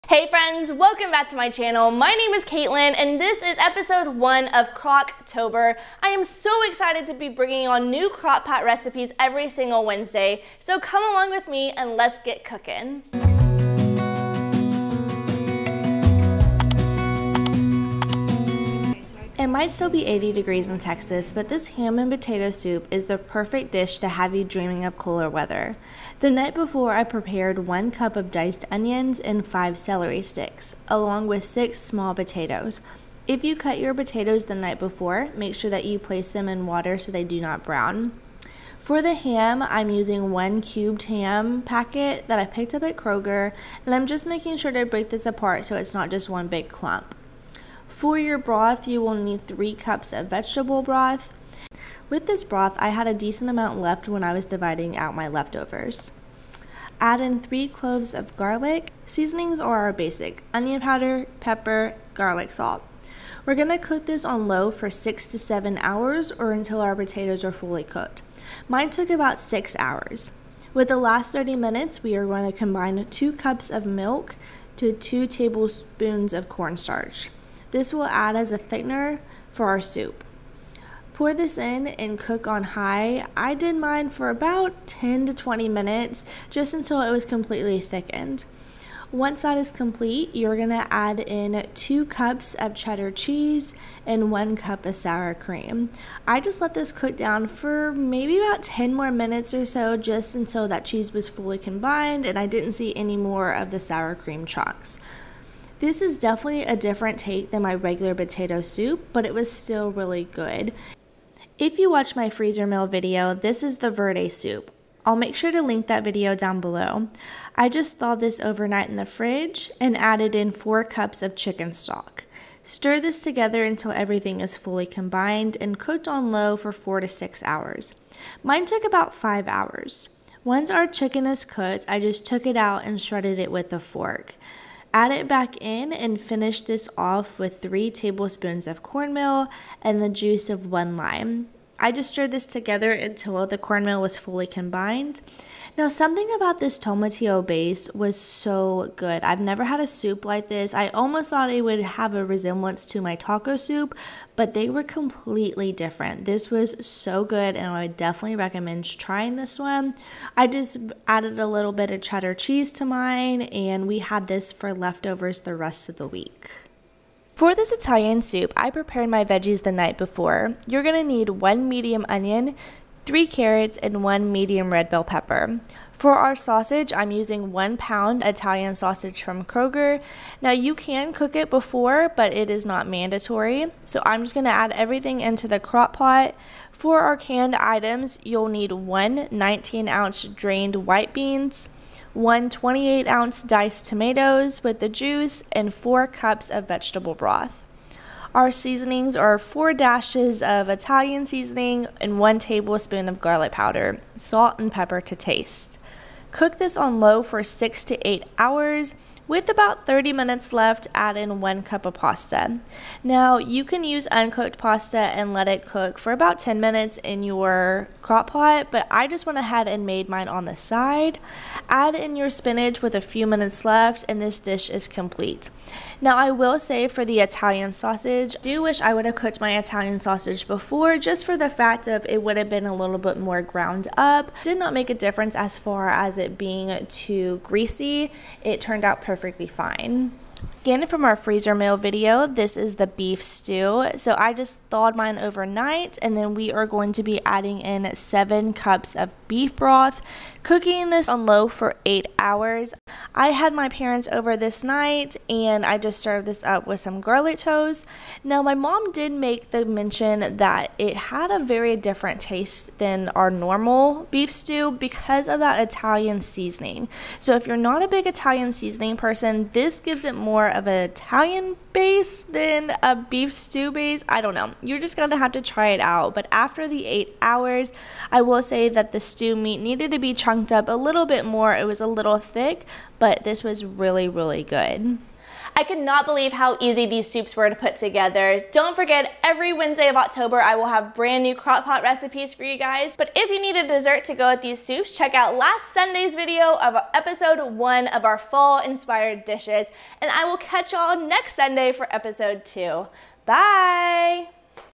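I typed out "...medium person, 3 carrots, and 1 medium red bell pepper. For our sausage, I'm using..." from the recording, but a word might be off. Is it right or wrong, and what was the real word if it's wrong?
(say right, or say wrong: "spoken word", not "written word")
wrong: "onion", not "person".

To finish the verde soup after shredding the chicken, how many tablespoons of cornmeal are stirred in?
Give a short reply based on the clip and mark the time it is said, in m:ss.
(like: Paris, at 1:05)
3, at 2:17.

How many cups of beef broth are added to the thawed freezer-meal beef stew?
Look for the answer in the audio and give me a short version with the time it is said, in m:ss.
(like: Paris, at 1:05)
7, at 4:07.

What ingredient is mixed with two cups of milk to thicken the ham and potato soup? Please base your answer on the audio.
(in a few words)
Cornstarch.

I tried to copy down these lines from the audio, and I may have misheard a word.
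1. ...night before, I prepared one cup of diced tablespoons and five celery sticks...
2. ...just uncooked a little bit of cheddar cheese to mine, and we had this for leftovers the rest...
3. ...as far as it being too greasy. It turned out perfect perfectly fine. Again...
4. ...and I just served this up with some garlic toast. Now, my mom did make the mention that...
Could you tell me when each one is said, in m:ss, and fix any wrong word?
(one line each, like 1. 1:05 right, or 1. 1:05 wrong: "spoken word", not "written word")
1. 0:26 wrong: "onions", not "tablespoons"
2. 2:40 wrong: "added", not "uncooked"
3. 3:55 right
4. 4:15 right.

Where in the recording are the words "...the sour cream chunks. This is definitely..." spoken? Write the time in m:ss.
1:43.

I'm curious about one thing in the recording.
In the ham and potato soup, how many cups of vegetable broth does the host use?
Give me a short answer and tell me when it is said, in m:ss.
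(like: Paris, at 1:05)
3 cups, at 0:49.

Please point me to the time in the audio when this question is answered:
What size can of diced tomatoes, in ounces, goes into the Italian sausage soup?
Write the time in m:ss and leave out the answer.
3:12.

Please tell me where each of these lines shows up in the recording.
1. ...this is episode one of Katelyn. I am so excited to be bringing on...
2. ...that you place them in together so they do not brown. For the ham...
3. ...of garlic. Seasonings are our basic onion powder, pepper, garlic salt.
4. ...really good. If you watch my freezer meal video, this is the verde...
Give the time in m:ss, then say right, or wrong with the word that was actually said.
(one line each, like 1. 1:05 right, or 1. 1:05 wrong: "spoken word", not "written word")
1. 0:03 wrong: "Crocktober", not "Katelyn"
2. 0:35 wrong: "water", not "together"
3. 0:58 right
4. 1:49 right.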